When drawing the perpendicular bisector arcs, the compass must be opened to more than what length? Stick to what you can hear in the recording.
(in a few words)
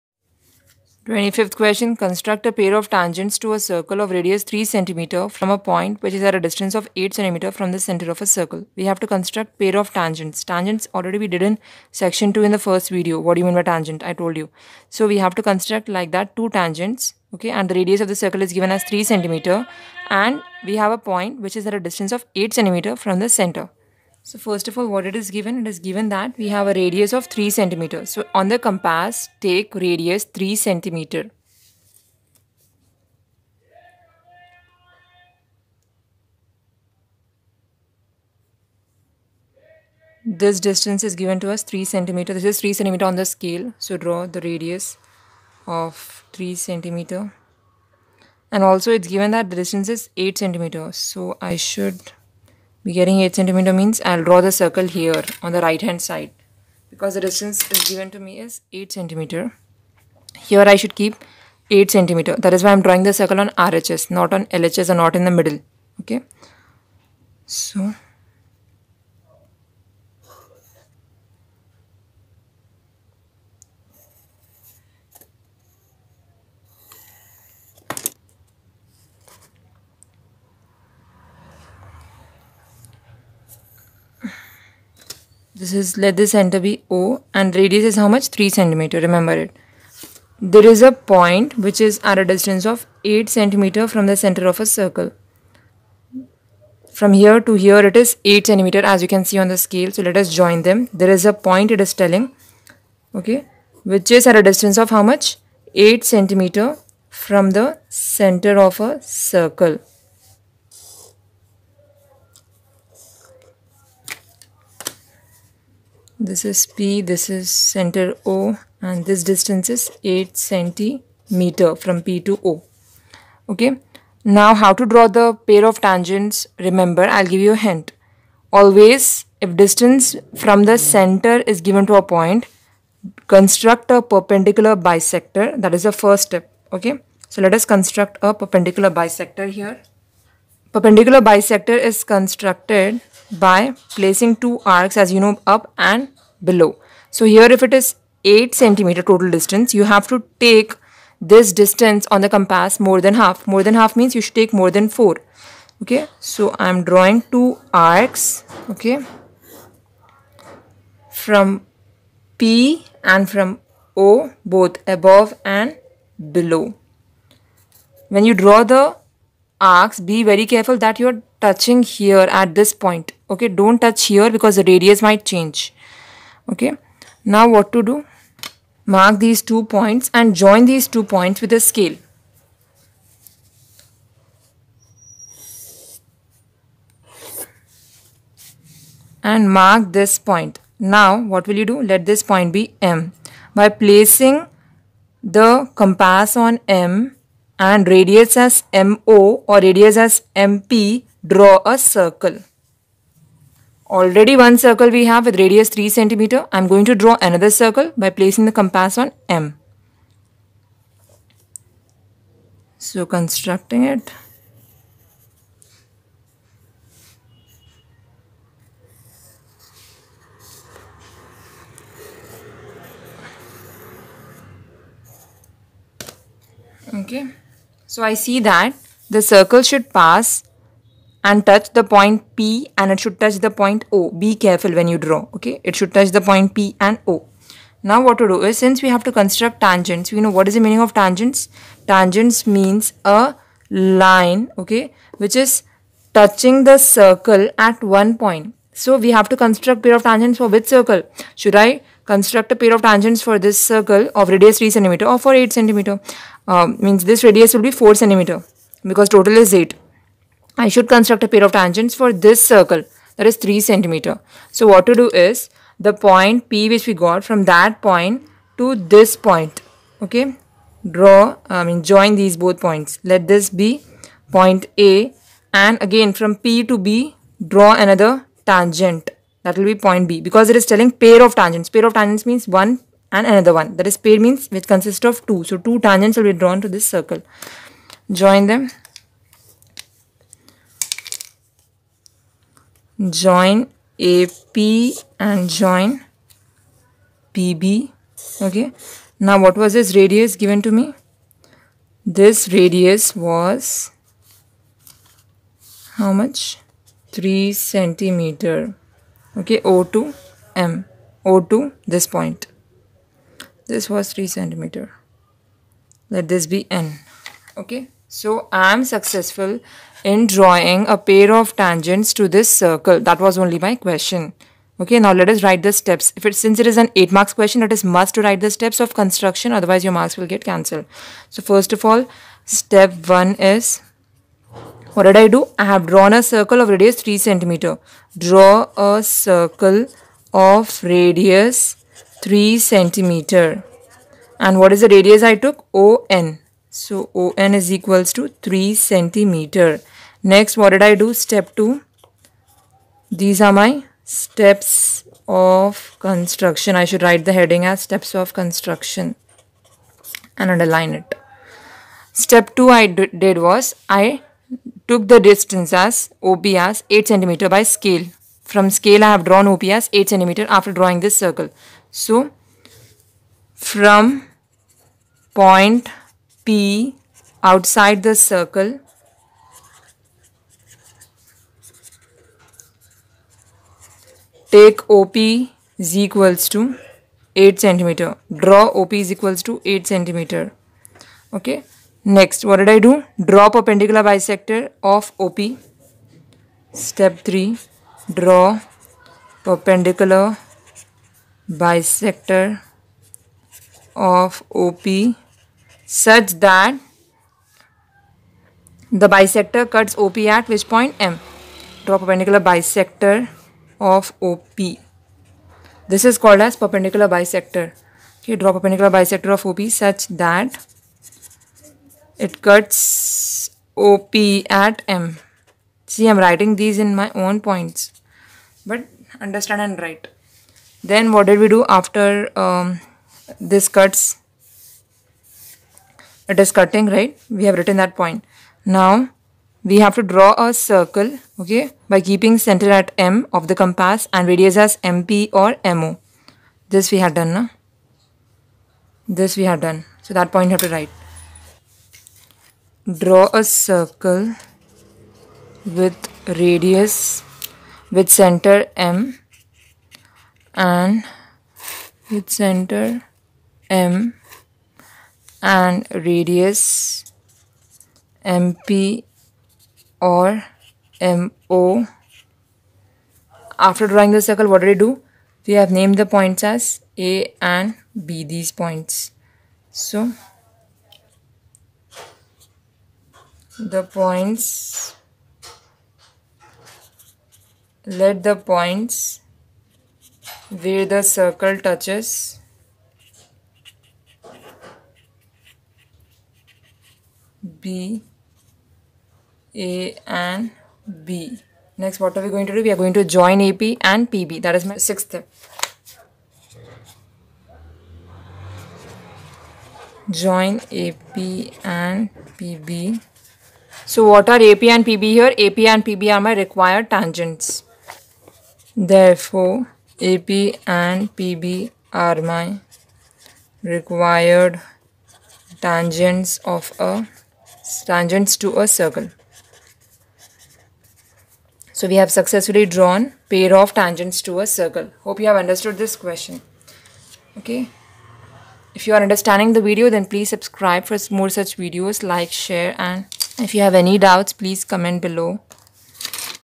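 4.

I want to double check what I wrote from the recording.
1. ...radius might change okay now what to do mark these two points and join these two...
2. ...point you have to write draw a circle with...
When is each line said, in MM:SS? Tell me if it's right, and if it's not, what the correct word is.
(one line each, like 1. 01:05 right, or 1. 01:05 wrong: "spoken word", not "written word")
1. 02:54 right
2. 07:30 right.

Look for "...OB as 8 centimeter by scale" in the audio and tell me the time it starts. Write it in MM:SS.
06:06.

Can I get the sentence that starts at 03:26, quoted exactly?
I'm going to draw another circle by placing the compass on M.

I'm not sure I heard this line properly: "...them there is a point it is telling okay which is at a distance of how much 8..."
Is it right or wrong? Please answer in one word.
right.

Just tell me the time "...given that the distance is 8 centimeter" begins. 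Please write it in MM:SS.
00:49.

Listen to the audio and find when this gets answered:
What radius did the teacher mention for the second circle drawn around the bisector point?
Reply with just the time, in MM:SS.
04:17.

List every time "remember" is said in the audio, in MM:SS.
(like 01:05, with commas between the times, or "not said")
01:29, 02:06.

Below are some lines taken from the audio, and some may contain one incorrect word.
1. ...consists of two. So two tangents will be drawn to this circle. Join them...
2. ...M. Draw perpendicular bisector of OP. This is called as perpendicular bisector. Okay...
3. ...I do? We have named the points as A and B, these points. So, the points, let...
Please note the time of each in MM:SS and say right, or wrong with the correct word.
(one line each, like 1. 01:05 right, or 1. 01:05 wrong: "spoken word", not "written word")
1. 04:44 right
2. 06:51 right
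3. 07:54 right.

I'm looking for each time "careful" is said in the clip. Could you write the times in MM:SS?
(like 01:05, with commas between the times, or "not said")
02:50, 03:54.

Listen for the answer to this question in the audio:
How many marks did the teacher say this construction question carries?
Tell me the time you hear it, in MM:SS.
05:26.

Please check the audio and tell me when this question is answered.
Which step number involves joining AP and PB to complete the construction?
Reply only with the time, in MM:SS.
08:24.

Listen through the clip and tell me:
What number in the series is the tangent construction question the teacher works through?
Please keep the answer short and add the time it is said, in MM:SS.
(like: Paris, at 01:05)
25th, at 00:01.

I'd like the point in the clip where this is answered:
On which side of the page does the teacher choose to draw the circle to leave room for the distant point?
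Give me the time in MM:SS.
00:55.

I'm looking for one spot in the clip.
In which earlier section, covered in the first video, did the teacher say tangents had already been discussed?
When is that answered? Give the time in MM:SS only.
00:11.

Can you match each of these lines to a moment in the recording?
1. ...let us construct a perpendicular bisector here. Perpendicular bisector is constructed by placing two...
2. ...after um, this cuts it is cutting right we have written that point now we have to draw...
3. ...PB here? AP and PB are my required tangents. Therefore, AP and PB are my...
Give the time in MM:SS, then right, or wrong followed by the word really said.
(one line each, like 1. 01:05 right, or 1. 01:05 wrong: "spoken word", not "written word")
1. 02:17 right
2. 07:11 right
3. 08:34 right.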